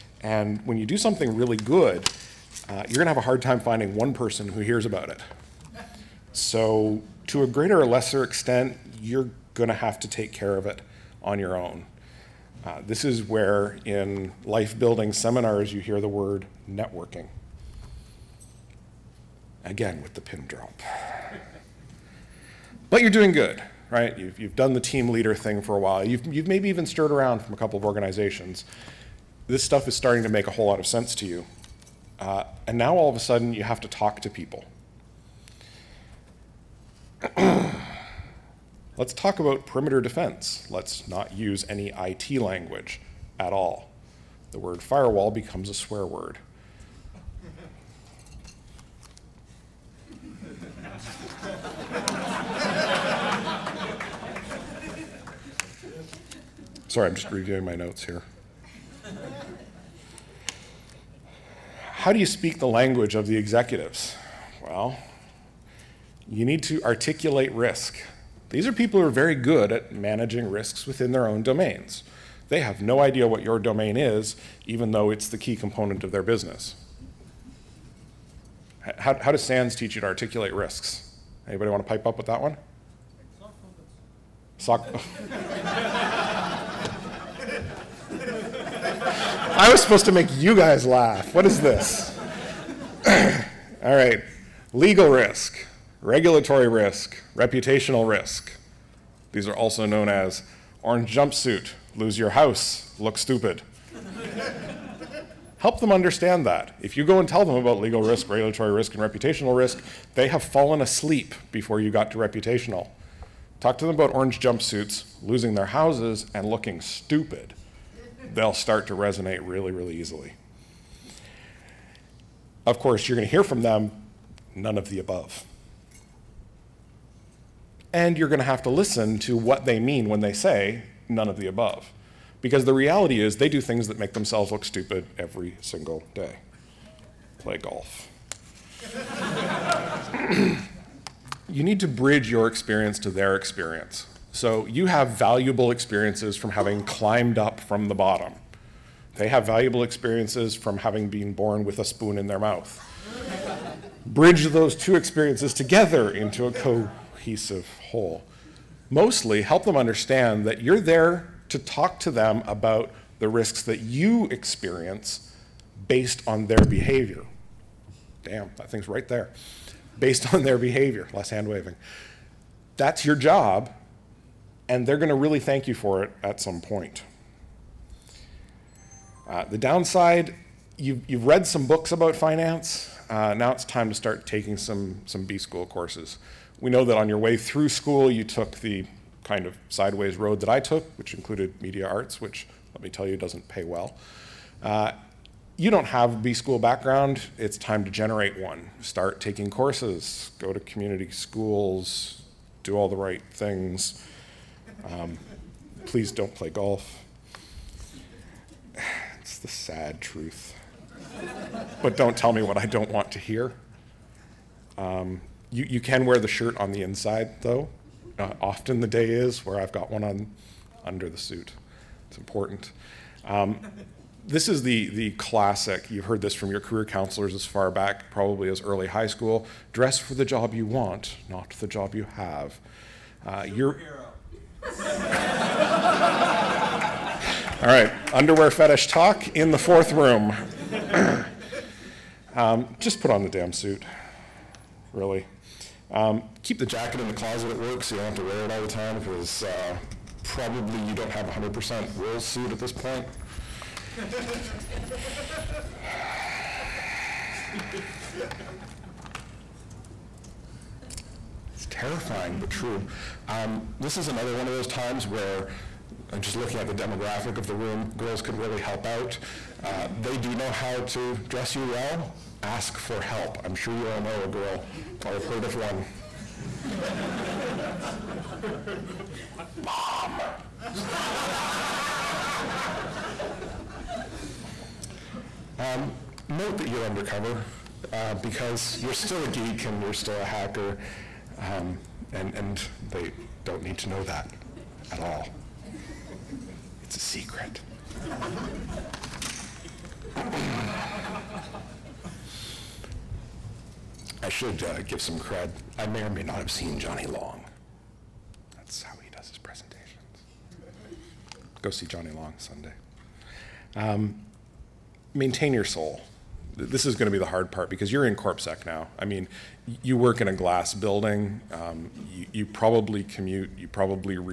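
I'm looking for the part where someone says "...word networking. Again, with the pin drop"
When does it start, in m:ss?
0:16.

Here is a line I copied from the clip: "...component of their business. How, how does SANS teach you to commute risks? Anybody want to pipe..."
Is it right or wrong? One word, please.
wrong.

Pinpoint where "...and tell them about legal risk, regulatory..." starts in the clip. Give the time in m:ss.
1:47.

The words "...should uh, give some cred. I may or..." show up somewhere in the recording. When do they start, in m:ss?
5:04.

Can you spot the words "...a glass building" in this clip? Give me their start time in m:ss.
5:20.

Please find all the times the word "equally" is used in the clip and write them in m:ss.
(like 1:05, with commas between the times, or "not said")
not said.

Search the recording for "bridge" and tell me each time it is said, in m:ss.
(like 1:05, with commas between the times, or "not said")
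2:21, 2:34.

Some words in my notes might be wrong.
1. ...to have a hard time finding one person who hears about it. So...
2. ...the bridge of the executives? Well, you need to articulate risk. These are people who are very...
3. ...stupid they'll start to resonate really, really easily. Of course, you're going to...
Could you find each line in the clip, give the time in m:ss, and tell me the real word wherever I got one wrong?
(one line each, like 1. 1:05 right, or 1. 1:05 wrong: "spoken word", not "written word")
1. 0:03 right
2. 1:02 wrong: "language", not "bridge"
3. 1:56 right.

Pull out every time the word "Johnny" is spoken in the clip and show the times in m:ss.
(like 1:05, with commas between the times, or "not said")
5:06, 5:11.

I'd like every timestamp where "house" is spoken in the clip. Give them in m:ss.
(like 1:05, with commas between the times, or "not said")
1:42, 1:55.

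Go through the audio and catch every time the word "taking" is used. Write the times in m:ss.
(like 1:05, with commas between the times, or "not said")
3:04, 3:19.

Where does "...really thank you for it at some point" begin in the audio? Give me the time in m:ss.
2:55.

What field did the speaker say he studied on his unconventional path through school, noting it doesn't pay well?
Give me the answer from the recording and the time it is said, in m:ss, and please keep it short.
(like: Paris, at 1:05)
media arts, at 3:11.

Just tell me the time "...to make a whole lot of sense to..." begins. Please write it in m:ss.
0:30.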